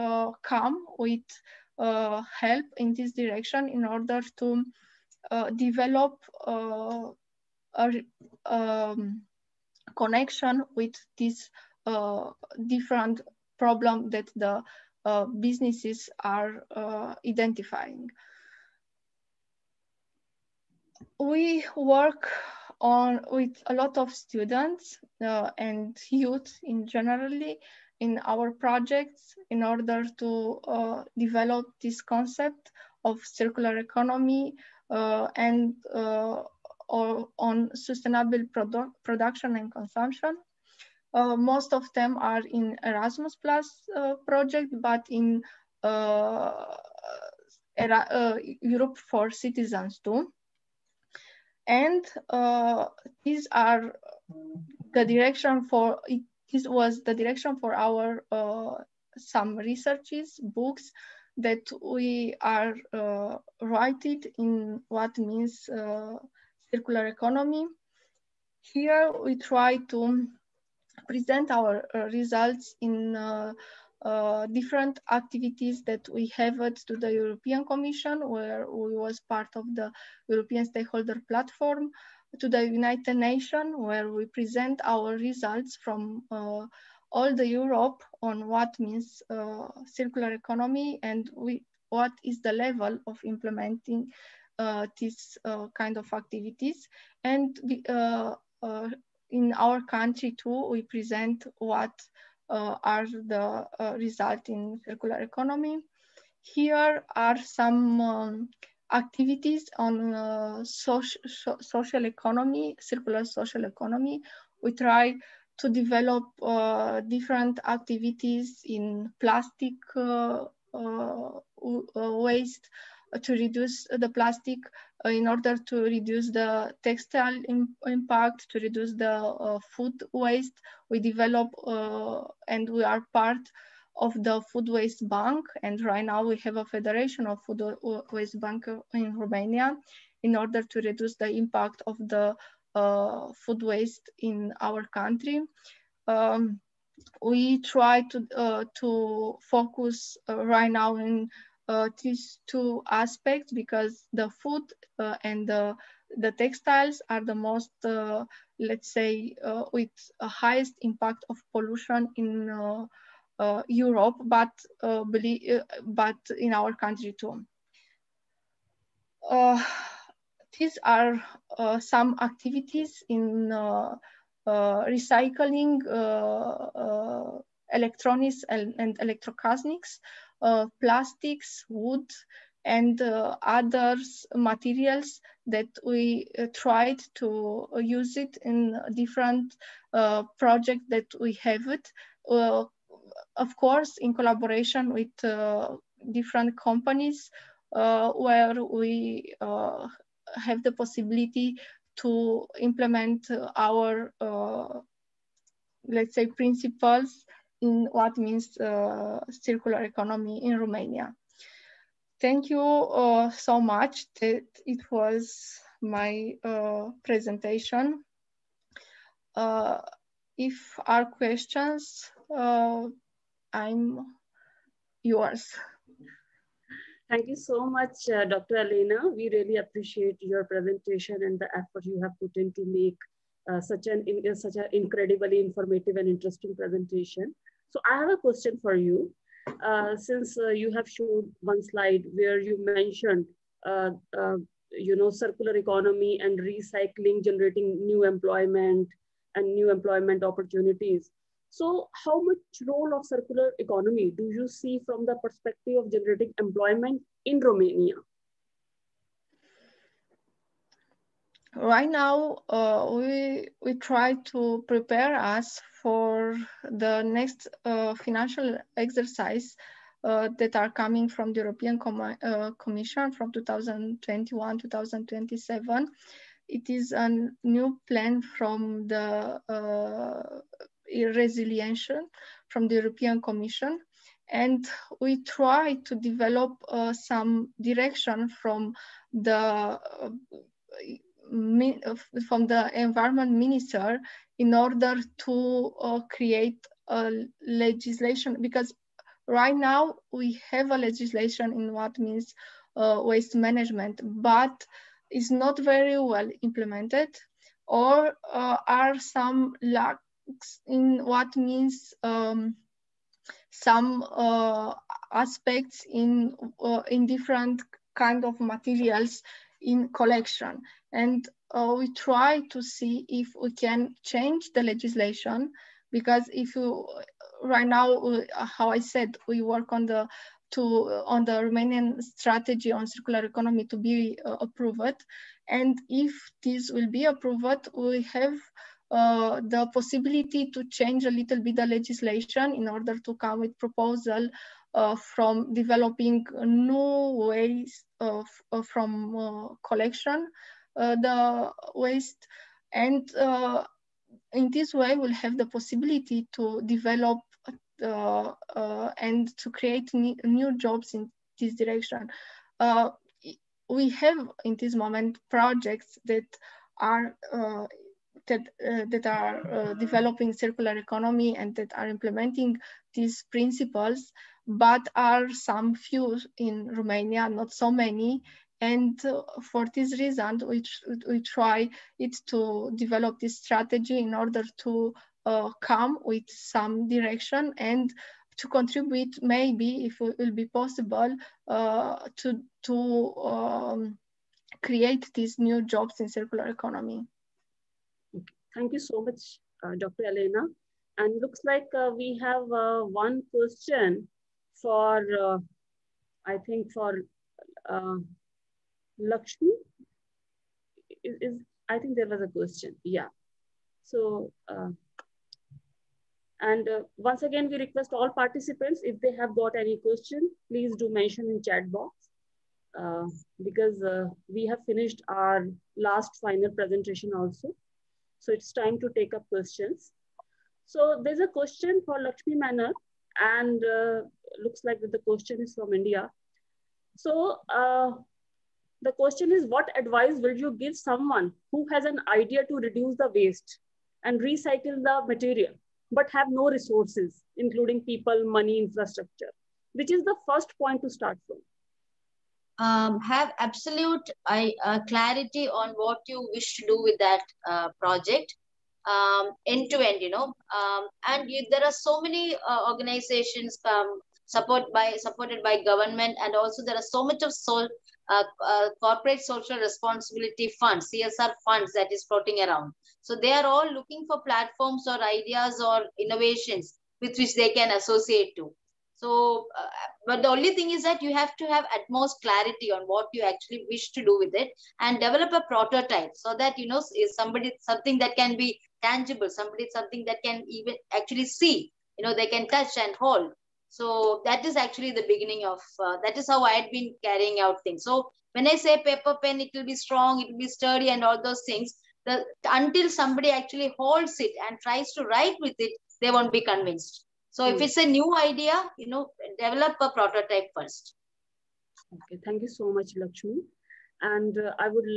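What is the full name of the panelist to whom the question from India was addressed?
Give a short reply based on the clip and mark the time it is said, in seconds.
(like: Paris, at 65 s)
Lakshmi Menon, at 431 s.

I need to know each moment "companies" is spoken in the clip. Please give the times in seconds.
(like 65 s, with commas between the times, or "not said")
196 s.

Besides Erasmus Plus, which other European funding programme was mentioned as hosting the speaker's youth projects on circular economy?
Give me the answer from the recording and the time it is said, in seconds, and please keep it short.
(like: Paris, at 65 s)
Europe for Citizens, at 48 s.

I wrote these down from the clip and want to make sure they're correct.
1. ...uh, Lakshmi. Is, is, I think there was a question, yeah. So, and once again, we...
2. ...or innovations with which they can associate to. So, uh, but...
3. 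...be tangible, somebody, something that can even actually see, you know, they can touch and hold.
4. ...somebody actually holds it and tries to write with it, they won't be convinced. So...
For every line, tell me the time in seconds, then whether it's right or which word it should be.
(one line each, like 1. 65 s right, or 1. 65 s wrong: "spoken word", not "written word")
1. 407 s right
2. 475 s right
3. 488 s right
4. 502 s right.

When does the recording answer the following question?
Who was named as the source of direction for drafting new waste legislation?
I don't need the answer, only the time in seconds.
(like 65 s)
292 s.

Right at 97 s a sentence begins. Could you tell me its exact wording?
And we, uh, uh, in our country too, we present what uh, are the result in circular economy.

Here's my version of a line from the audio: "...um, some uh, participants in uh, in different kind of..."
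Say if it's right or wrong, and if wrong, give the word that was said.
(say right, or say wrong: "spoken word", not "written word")
wrong: "aspects", not "participants".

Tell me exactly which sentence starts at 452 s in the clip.
um, have absolute uh, clarity on what you wish to do with that uh, project um, end to end, you know.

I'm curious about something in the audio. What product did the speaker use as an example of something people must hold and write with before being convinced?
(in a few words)
paper pen.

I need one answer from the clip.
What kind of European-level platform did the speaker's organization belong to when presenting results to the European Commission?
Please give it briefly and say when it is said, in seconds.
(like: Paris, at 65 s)
European Stakeholder Platform, at 80 s.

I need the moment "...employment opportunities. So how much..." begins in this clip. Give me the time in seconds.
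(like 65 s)
249 s.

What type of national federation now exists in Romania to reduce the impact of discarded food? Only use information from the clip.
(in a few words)
federation of food waste bank.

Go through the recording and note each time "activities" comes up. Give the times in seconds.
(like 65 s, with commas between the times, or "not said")
75 s, 96 s, 108 s, 117 s, 172 s.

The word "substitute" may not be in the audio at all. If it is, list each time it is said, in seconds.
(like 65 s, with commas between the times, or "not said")
not said.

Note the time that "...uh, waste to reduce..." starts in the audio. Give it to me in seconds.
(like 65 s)
120 s.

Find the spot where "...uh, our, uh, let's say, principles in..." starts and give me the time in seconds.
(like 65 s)
203 s.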